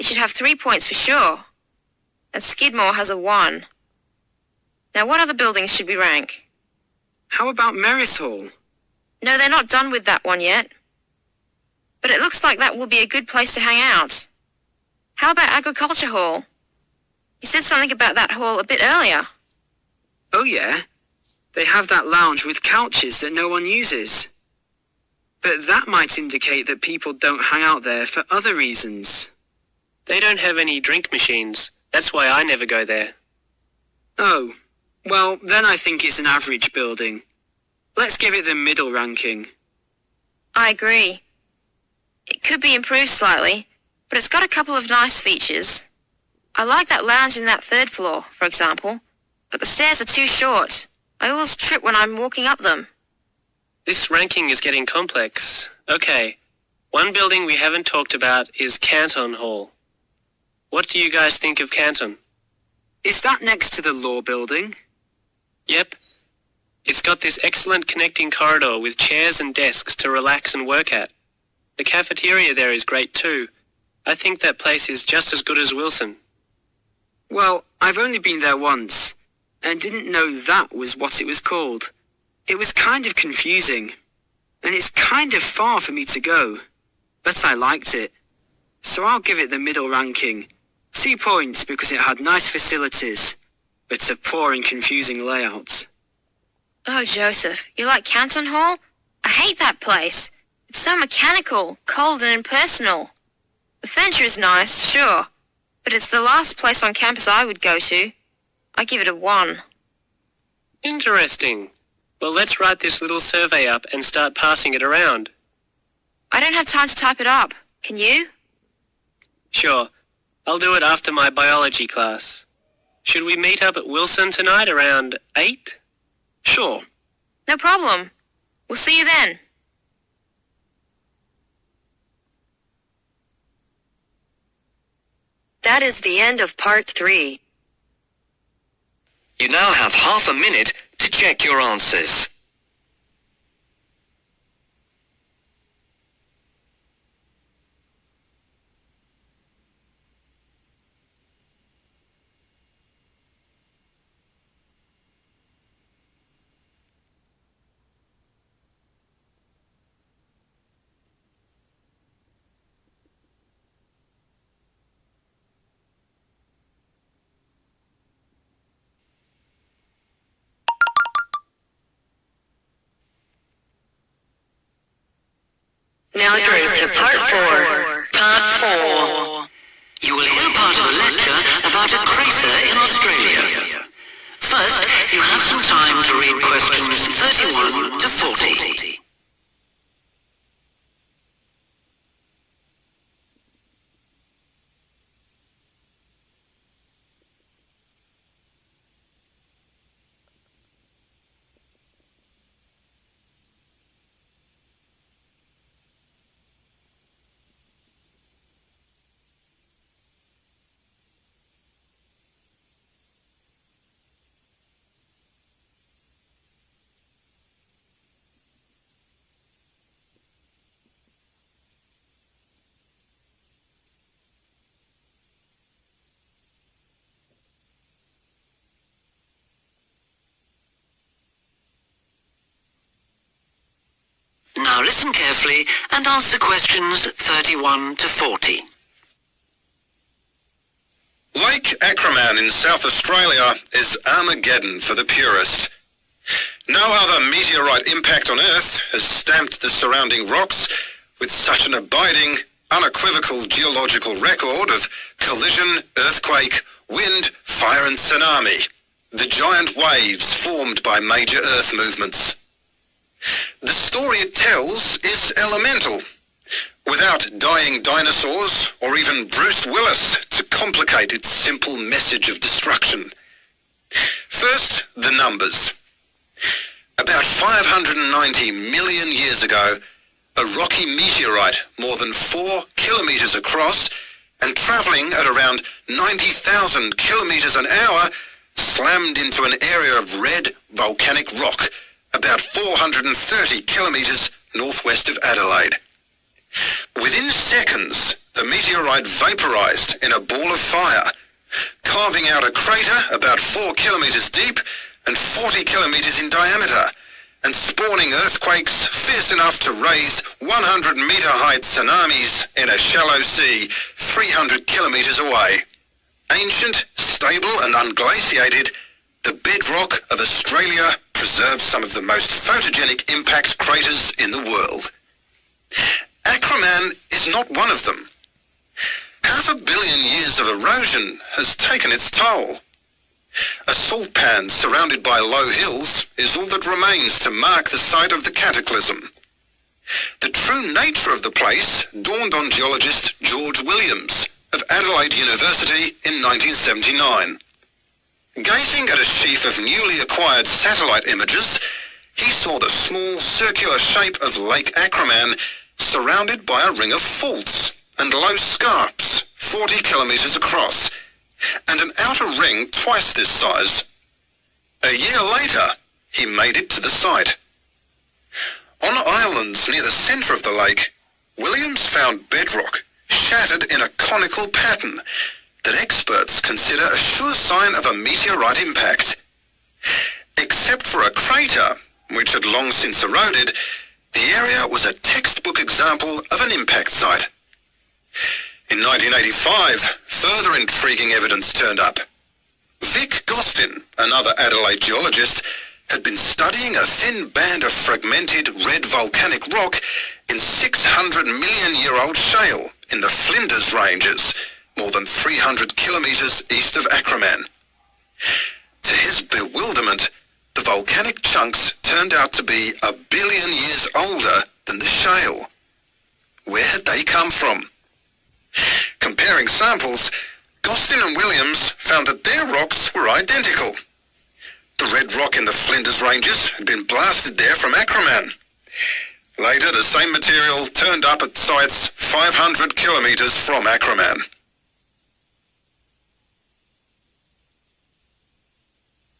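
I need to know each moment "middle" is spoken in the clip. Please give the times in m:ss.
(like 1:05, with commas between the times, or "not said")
0:38, 1:29.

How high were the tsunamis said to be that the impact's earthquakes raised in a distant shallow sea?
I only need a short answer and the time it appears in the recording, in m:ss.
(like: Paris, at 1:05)
100 metres, at 5:10.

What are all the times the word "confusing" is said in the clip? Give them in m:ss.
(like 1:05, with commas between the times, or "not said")
1:23, 1:34.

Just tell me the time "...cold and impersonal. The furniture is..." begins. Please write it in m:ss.
1:41.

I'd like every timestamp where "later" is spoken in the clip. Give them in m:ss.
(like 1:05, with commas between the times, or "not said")
6:05, 7:09.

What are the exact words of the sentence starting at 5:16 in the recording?
Ancient, stable and unglaciated, the bedrock of Australia preserves some of the most photogenic impact craters in the world.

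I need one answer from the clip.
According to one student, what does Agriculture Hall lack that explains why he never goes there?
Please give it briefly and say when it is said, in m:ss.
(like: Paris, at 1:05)
drink machines, at 0:30.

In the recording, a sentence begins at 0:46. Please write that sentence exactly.
I like that lounge in that third floor, for example, but the stairs are too short.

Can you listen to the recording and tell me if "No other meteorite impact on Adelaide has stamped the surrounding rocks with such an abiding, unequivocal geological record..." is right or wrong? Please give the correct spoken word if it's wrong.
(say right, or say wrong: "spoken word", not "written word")
wrong: "Earth", not "Adelaide".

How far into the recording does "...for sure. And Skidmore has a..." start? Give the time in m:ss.
0:00.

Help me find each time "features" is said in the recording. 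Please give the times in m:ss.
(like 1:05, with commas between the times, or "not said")
0:45.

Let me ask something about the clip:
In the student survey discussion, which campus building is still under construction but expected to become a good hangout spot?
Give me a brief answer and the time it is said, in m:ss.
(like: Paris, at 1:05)
Merris Hall, at 0:07.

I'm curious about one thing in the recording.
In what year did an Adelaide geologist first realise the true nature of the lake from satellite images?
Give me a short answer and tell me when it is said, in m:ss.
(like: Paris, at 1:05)
1979, at 5:46.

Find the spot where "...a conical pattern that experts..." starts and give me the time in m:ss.
6:13.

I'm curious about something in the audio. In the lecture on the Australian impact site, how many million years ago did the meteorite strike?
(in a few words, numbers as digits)
590.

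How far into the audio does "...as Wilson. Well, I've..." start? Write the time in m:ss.
1:15.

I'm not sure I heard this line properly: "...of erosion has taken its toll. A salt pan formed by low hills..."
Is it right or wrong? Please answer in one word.
wrong.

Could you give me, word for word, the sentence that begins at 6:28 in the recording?
In 1985, further intriguing evidence turned up.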